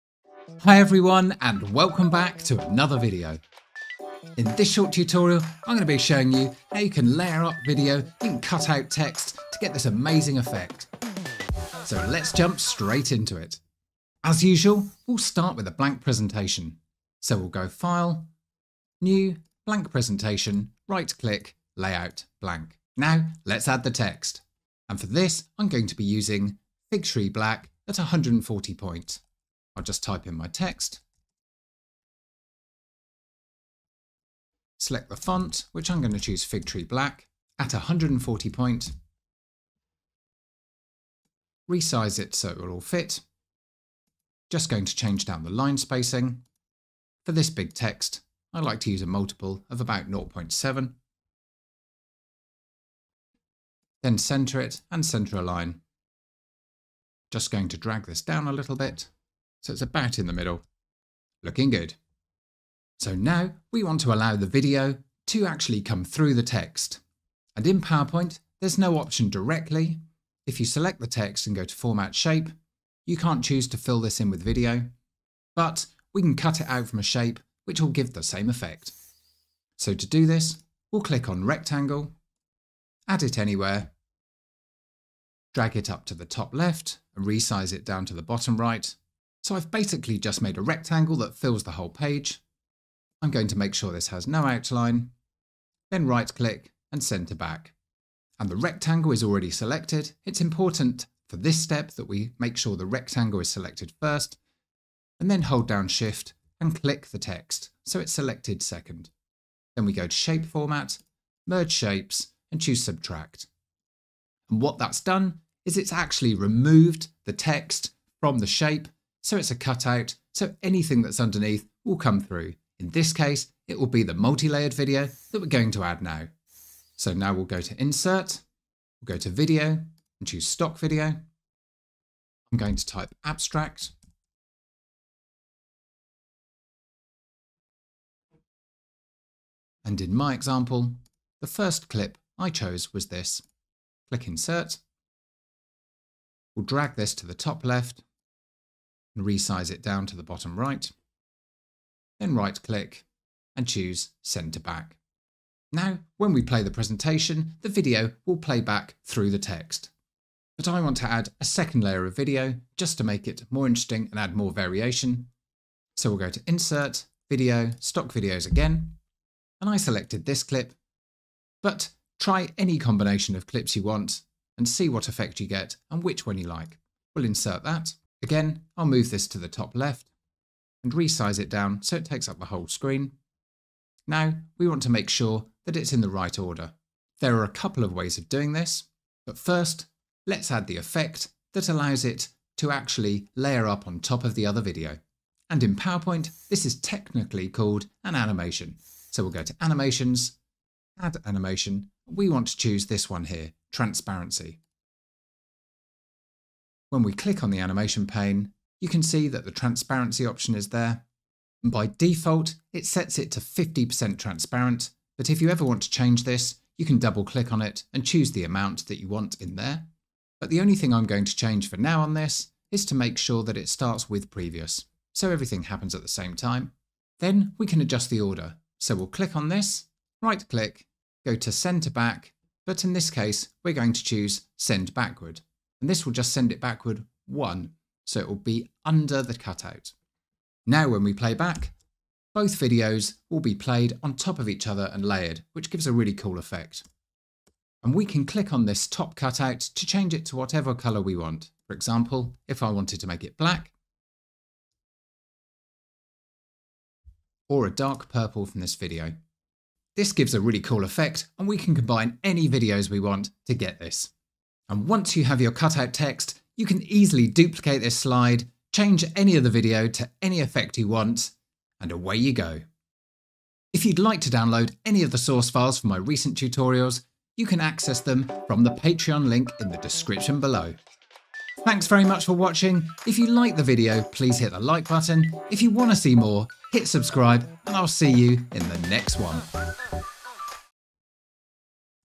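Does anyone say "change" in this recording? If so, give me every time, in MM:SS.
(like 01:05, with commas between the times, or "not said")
00:44, 03:35, 03:41, 04:09, 04:28.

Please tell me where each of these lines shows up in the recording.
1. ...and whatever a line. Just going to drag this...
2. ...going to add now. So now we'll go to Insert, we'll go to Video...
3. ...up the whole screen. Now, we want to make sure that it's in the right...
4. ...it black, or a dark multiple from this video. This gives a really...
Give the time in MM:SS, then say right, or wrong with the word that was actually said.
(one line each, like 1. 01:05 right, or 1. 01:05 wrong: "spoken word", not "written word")
1. 00:54 wrong: "center", not "whatever"
2. 02:05 right
3. 03:02 right
4. 04:13 wrong: "purple", not "multiple".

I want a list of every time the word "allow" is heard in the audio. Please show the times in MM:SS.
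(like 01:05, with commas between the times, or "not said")
01:04, 03:11.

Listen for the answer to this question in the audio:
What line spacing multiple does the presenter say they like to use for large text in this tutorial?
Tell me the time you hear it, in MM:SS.
00:50.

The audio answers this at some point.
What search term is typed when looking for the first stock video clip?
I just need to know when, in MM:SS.
02:13.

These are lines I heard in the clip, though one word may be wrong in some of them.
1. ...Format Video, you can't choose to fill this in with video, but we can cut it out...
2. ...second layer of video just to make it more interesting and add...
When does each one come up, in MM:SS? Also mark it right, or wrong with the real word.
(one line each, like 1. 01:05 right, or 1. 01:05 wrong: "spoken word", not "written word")
1. 01:11 wrong: "Shape", not "Video"
2. 02:41 right.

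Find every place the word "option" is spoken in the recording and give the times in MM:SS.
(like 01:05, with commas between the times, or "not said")
01:08, 03:30.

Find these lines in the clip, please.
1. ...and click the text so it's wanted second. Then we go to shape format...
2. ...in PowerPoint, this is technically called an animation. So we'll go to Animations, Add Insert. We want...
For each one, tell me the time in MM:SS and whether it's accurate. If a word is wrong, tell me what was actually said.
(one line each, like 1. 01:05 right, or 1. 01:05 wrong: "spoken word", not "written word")
1. 01:46 wrong: "selected", not "wanted"
2. 03:15 wrong: "Animation", not "Insert".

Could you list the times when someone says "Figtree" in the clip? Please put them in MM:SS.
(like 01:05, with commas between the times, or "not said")
00:26, 00:36.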